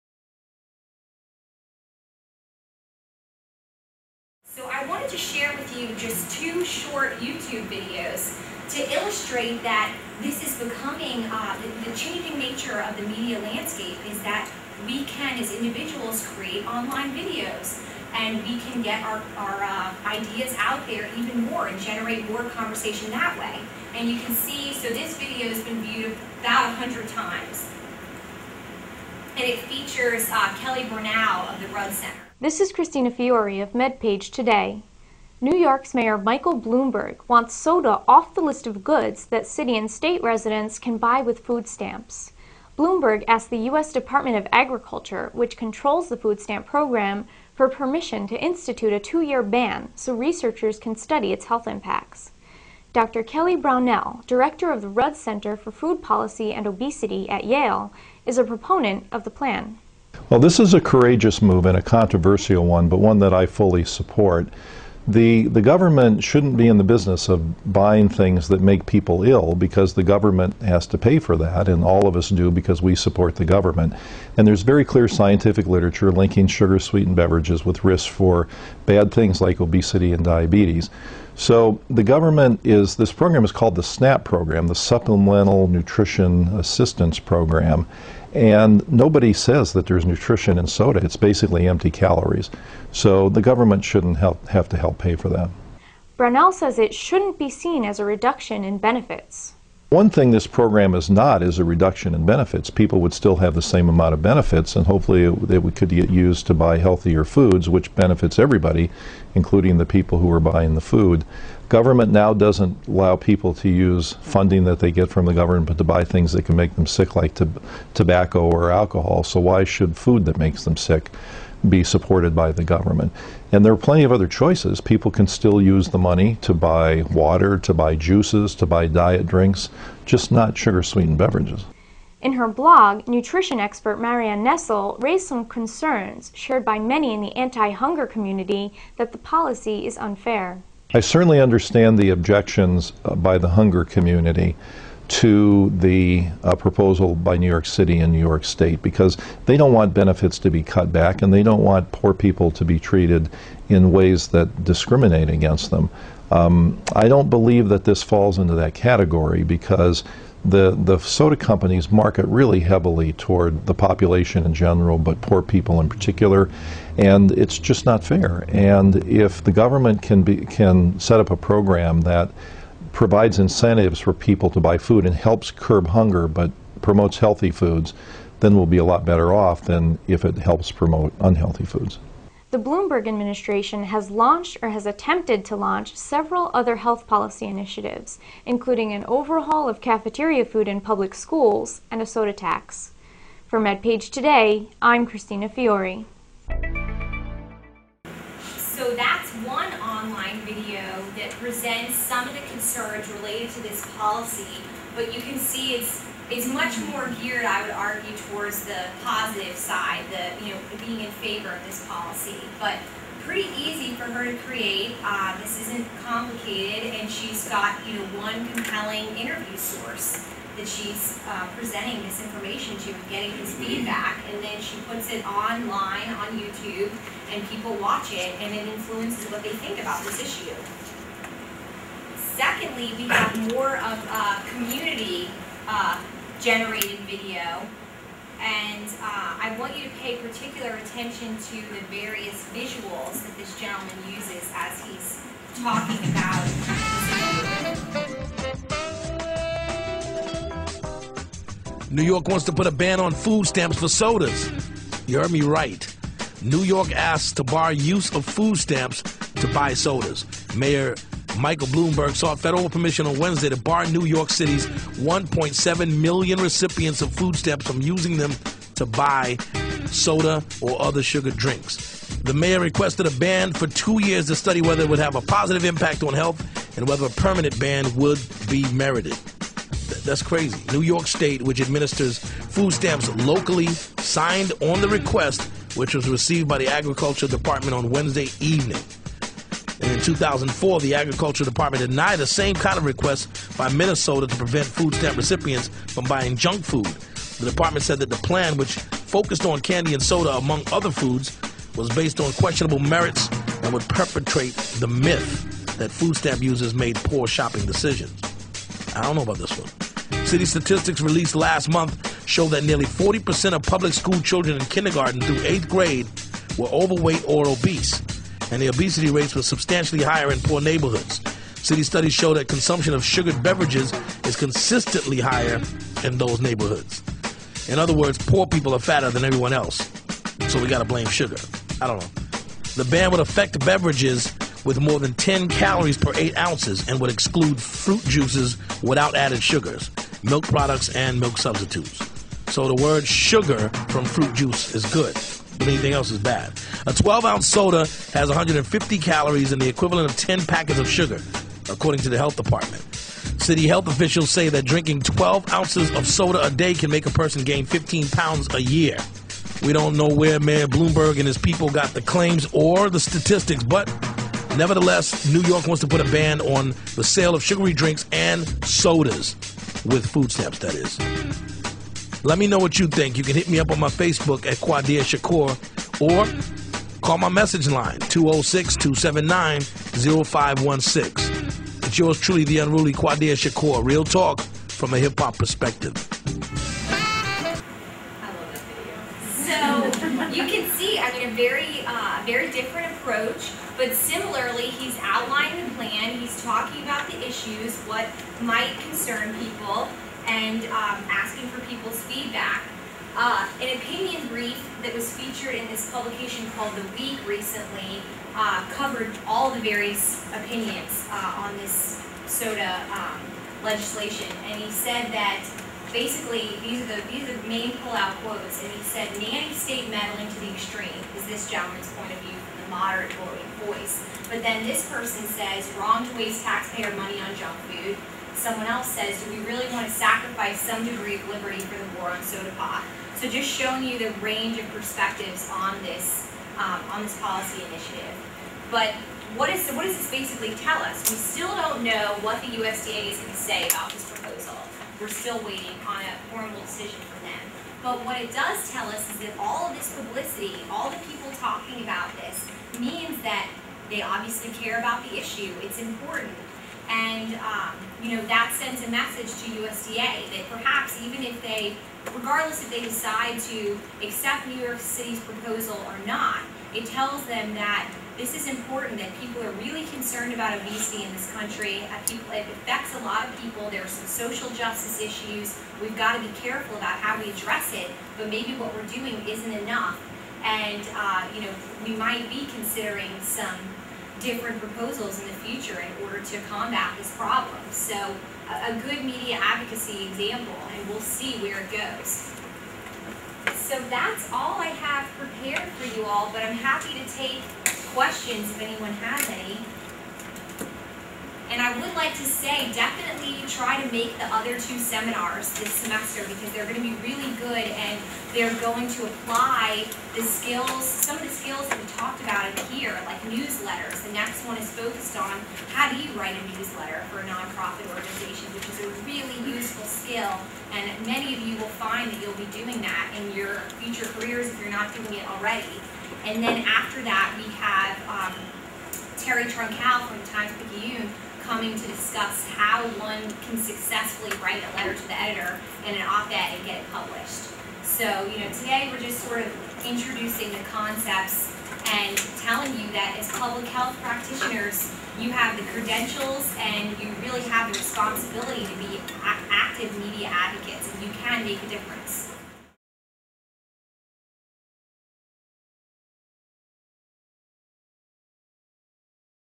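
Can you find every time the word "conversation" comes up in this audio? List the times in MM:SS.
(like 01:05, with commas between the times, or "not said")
00:22.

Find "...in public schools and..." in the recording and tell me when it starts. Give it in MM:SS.
03:10.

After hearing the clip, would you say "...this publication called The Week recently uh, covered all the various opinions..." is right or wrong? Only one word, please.
right.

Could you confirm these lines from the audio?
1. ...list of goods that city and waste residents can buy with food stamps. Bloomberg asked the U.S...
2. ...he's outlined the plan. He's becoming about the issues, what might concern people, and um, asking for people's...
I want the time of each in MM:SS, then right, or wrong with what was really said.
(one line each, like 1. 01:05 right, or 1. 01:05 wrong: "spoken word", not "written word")
1. 00:38 wrong: "state", not "waste"
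2. 06:34 wrong: "talking", not "becoming".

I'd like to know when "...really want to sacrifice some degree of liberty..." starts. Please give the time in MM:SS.
07:09.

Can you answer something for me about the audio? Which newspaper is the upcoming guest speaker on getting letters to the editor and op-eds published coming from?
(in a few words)
Times Picayune.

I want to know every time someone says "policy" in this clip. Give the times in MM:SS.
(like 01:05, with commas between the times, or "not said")
00:56, 02:19, 03:07, 03:23, 03:31, 07:17.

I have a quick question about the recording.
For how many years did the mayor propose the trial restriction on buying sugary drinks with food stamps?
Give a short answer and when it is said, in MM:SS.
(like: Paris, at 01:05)
2, at 00:48.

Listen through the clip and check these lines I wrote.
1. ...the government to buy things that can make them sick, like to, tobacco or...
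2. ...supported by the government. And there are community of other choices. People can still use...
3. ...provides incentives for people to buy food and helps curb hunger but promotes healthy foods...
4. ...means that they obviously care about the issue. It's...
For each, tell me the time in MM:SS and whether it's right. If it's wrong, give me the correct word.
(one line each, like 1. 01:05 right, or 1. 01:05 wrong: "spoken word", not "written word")
1. 01:55 right
2. 02:01 wrong: "plenty", not "community"
3. 02:52 right
4. 07:32 right.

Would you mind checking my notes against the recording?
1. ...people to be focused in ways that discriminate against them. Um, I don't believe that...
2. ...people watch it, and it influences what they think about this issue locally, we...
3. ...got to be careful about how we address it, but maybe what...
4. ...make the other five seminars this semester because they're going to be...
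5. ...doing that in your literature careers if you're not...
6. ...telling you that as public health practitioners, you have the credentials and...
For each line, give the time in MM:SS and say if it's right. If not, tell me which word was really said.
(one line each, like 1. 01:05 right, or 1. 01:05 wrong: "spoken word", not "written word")
1. 02:32 wrong: "treated", not "focused"
2. 03:47 wrong: "secondly", not "locally"
3. 07:55 right
4. 08:23 wrong: "two", not "five"
5. 08:42 wrong: "future", not "literature"
6. 09:02 right.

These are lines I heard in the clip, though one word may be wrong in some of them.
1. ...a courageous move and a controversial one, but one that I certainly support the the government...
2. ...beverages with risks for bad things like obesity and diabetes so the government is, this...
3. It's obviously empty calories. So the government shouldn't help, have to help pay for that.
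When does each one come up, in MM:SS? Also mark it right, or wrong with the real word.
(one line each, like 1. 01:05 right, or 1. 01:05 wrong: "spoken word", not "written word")
1. 01:00 wrong: "fully", not "certainly"
2. 01:17 right
3. 01:31 wrong: "basically", not "obviously".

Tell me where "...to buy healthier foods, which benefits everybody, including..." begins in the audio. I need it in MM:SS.
01:46.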